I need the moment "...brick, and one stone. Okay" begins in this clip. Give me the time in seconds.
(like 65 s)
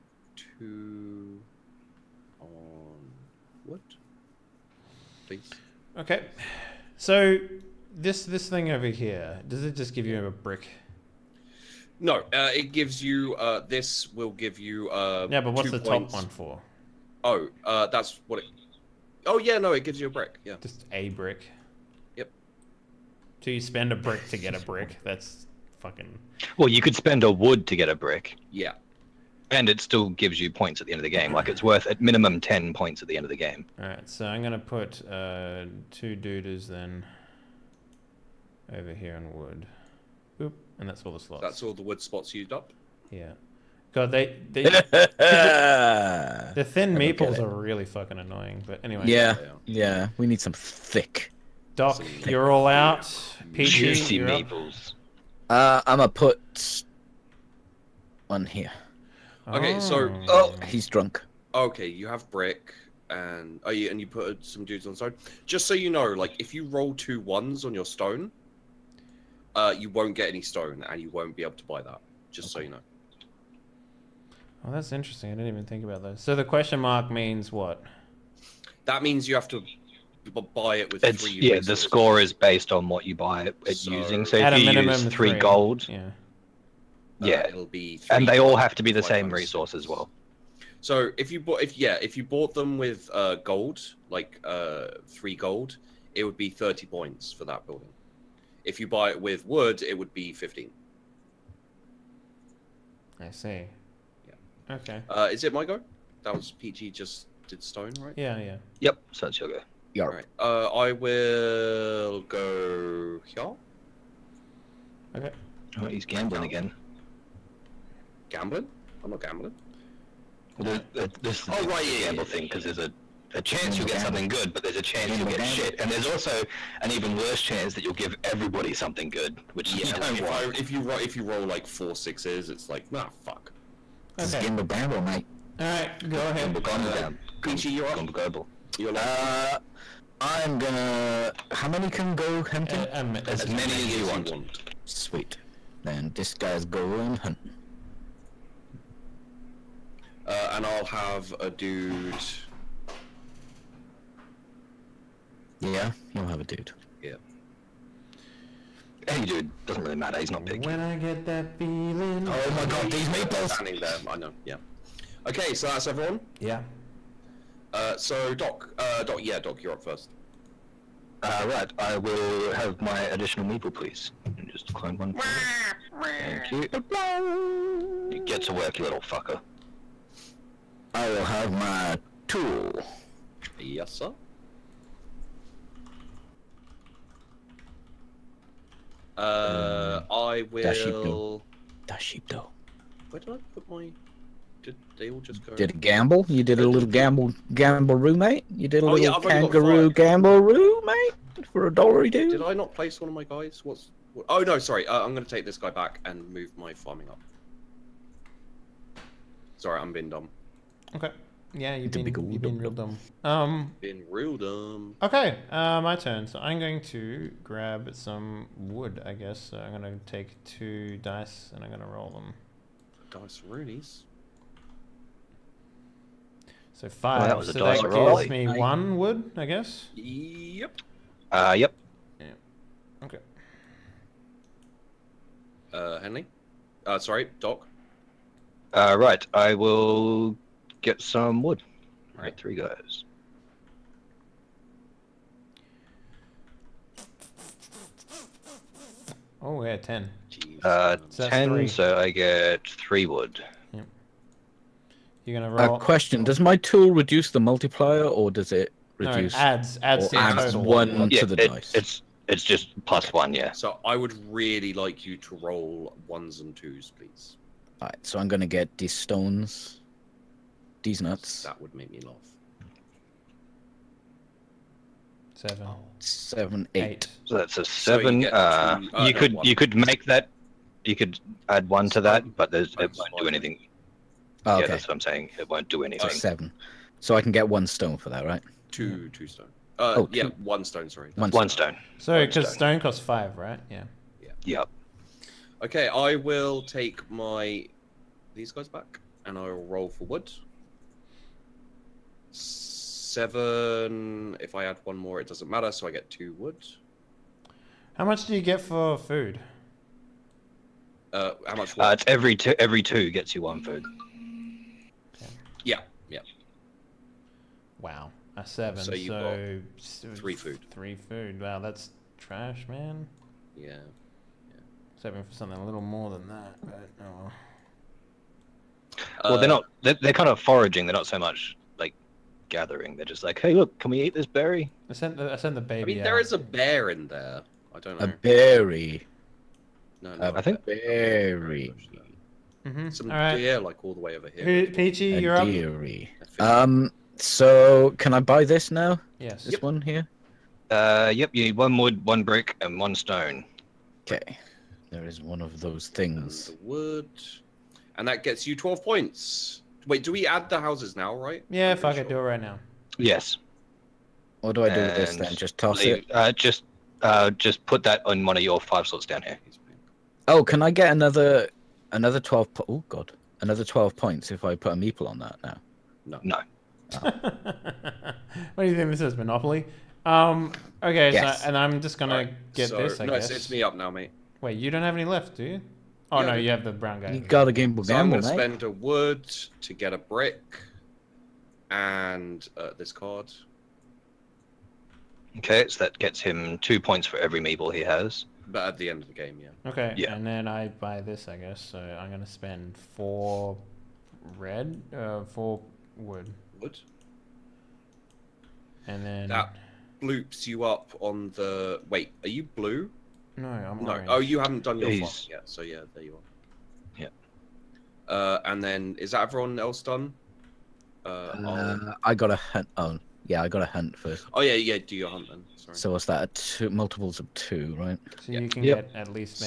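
352 s.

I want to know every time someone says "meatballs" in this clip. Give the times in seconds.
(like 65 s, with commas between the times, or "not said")
163 s, 173 s.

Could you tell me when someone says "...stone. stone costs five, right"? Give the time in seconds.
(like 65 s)
292 s.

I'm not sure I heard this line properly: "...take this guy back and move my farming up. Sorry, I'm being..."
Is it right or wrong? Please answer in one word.
right.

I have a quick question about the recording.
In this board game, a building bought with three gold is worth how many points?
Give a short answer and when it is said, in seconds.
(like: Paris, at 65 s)
30, at 96 s.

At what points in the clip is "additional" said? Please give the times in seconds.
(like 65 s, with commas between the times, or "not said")
173 s.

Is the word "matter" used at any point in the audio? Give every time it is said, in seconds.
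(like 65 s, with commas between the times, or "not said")
159 s, 305 s.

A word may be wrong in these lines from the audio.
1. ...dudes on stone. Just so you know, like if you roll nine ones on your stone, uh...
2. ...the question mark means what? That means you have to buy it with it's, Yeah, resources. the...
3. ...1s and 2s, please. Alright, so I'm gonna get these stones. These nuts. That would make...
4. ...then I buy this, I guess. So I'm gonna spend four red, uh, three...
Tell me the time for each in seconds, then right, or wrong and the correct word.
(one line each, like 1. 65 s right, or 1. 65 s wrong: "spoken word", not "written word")
1. 64 s wrong: "two", not "nine"
2. 76 s right
3. 266 s right
4. 400 s wrong: "four", not "three".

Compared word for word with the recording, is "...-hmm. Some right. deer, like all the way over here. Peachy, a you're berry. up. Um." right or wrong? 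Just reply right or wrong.
wrong.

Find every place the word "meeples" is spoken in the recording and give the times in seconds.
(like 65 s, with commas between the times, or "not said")
46 s, 54 s, 374 s, 397 s.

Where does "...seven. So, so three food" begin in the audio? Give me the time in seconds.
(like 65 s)
318 s.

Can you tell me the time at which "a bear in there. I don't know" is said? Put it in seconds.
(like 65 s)
336 s.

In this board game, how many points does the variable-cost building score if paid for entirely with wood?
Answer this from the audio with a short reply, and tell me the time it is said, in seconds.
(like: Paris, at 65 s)
15, at 100 s.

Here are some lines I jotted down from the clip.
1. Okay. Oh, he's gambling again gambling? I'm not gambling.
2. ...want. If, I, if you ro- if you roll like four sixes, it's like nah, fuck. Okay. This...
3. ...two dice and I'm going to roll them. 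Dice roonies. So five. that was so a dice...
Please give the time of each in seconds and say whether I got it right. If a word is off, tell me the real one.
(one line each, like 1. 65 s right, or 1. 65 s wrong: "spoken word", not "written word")
1. 115 s right
2. 130 s right
3. 220 s right.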